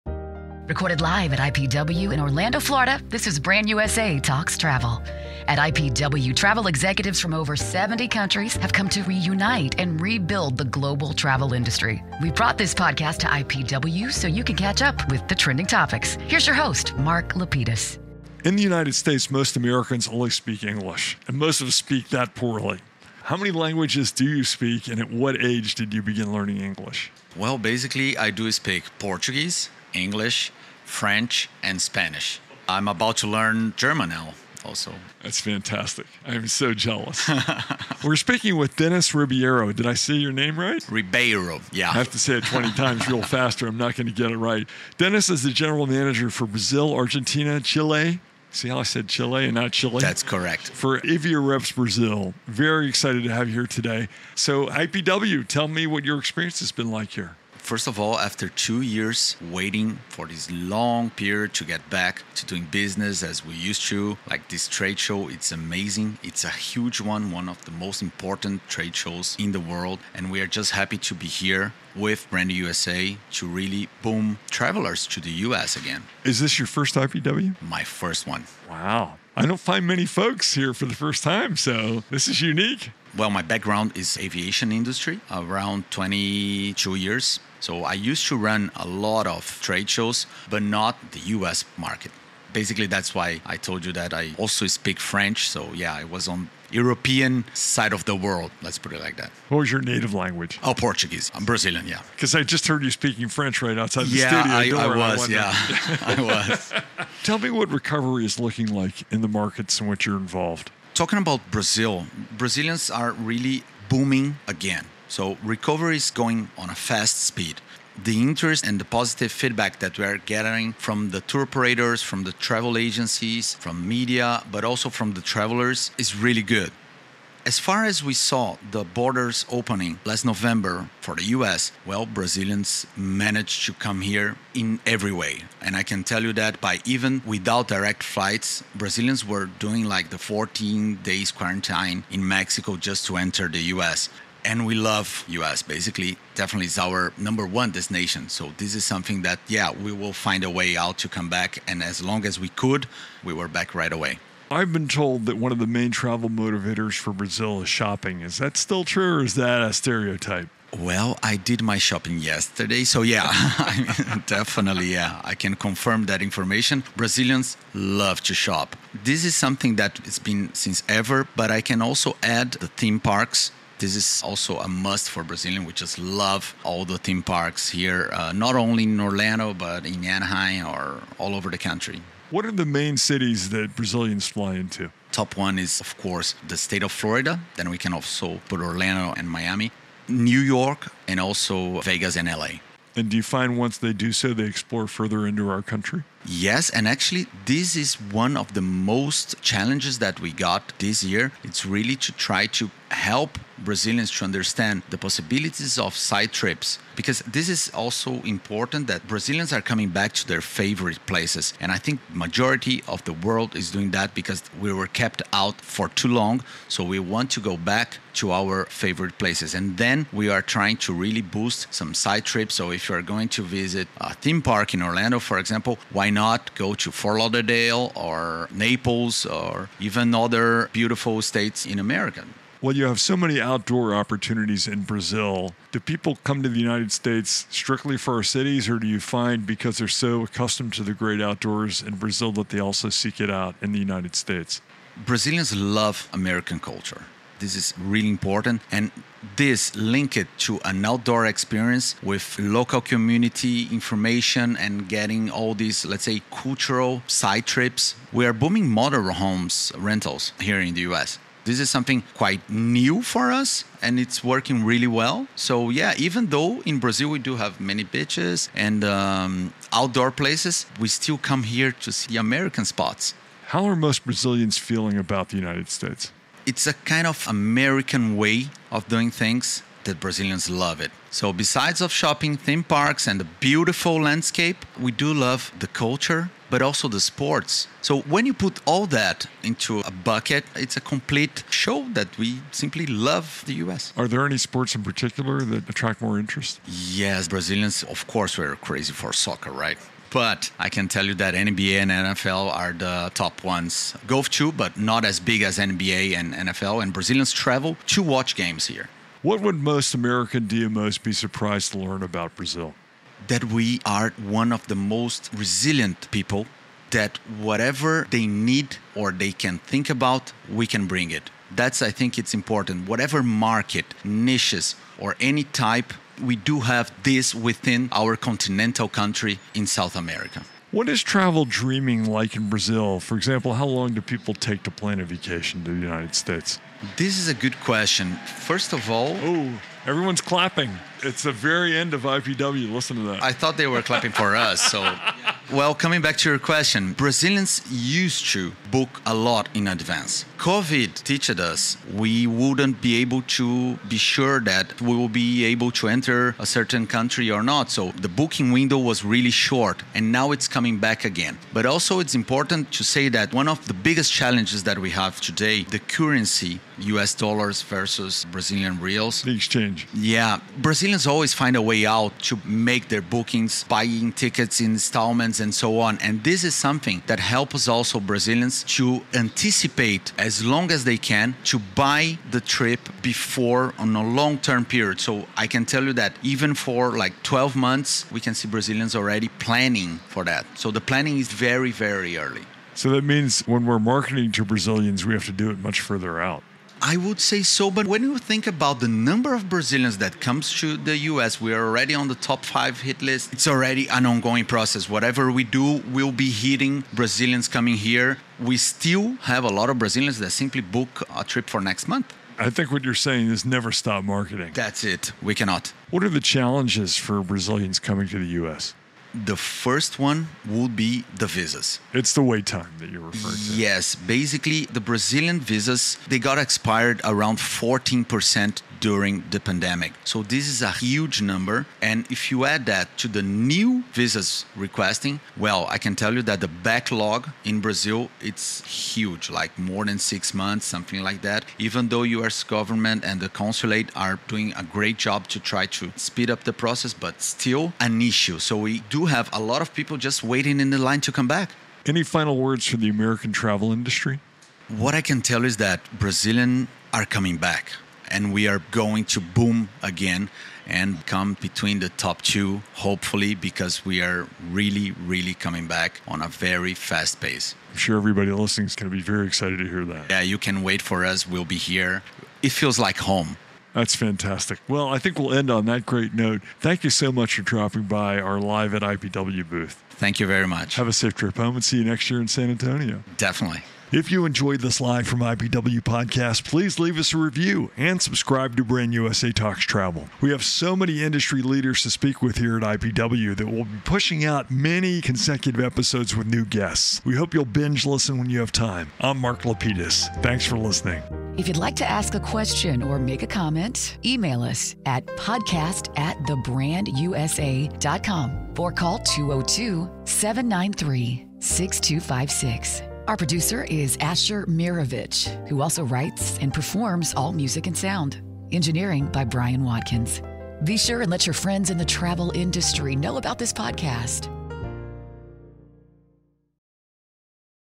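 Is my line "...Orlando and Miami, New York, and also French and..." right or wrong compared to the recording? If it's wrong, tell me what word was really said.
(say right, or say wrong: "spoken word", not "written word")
wrong: "Vegas", not "French".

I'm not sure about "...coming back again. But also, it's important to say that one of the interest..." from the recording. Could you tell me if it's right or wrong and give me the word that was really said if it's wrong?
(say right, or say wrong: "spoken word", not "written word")
wrong: "biggest", not "interest".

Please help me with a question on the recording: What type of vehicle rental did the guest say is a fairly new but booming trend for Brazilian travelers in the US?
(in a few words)
Motorhomes.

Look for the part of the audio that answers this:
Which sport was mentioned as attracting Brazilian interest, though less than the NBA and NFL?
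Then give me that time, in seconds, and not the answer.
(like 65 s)
304 s.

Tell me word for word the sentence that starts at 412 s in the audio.
I think what you're saying is never stop marketing.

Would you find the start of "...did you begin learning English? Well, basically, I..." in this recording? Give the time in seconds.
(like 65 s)
25 s.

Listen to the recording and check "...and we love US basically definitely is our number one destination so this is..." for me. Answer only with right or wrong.
right.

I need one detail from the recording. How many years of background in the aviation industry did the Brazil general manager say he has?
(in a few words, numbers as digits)
22.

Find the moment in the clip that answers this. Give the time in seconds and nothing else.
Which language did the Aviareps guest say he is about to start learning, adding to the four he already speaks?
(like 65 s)
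33 s.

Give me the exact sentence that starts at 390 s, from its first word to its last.
So the planning is very, very early.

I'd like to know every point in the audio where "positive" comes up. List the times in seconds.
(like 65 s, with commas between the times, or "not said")
118 s.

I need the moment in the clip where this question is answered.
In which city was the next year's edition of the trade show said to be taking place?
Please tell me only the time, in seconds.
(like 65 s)
482 s.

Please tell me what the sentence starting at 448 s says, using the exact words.
So we do have a lot of people just waiting in the line to come back.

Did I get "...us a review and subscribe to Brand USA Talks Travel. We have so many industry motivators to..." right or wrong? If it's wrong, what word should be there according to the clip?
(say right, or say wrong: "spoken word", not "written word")
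wrong: "leaders", not "motivators".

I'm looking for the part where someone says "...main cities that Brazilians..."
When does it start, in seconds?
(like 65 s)
182 s.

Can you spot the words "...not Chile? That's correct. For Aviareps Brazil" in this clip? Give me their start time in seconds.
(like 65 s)
49 s.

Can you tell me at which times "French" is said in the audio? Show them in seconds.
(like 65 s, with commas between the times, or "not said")
30 s, 94 s, 103 s.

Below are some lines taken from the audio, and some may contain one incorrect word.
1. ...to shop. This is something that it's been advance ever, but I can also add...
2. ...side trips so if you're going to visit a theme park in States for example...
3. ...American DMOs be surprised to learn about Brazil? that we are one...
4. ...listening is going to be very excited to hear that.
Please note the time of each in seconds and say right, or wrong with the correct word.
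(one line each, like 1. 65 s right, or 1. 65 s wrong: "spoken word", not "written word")
1. 168 s wrong: "since", not "advance"
2. 221 s wrong: "Orlando", not "States"
3. 309 s right
4. 468 s right.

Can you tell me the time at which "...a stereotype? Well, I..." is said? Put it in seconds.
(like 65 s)
159 s.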